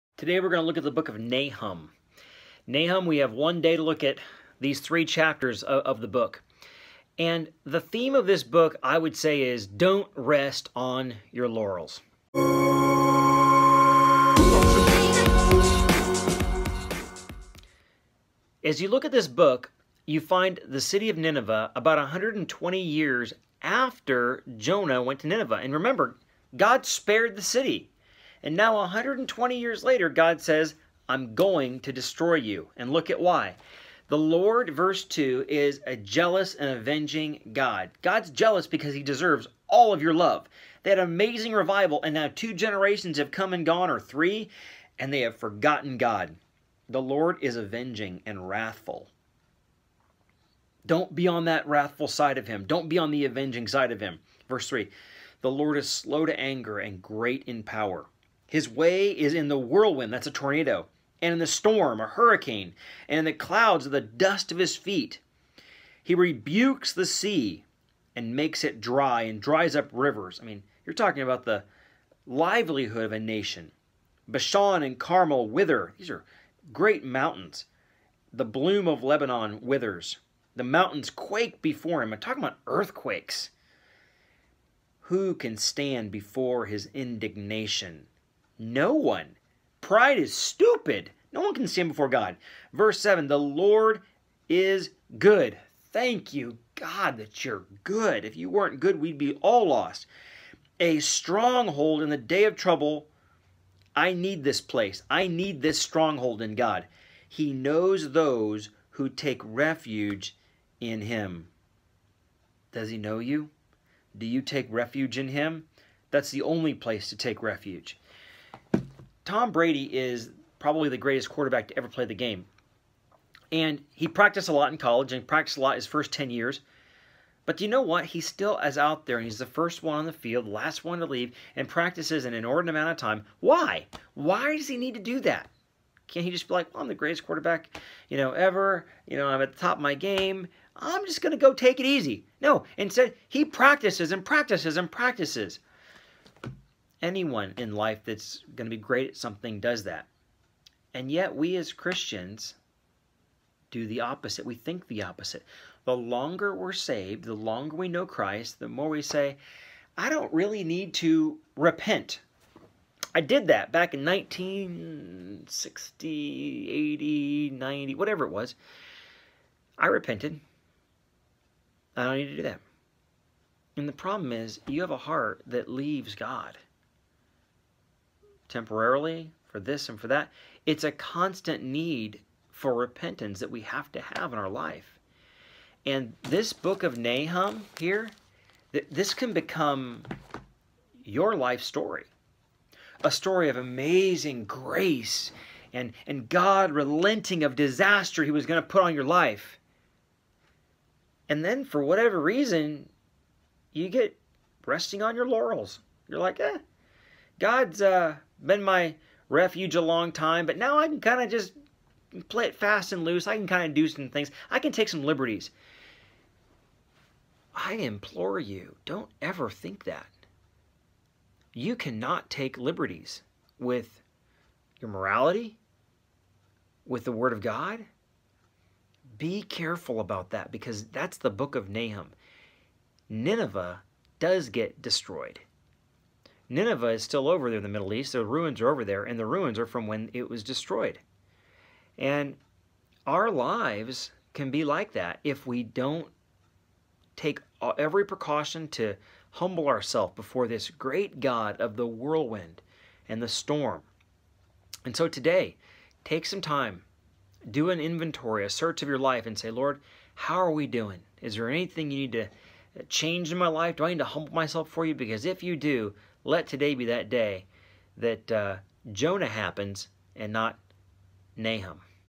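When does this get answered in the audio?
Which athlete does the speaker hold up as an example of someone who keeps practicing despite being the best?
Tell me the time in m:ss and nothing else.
1:59.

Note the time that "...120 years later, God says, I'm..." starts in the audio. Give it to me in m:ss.
0:28.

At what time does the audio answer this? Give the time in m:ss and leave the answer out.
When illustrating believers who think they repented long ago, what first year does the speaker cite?
2:44.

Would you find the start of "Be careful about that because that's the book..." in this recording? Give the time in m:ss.
3:49.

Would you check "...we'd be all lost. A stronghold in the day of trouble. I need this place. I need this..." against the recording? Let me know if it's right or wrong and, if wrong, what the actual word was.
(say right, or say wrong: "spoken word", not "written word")
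right.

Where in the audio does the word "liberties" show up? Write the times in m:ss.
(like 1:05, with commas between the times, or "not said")
3:35, 3:42.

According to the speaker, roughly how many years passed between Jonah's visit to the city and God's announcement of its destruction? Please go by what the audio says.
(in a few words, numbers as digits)
120.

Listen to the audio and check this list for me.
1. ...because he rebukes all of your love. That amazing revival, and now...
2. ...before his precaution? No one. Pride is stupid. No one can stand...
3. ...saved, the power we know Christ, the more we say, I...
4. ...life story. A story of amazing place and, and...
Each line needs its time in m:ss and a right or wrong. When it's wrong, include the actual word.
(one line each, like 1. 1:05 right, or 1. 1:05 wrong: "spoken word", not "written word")
1. 0:38 wrong: "deserves", not "rebukes"
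2. 1:26 wrong: "indignation", not "precaution"
3. 2:36 wrong: "longer", not "power"
4. 3:11 wrong: "grace", not "place".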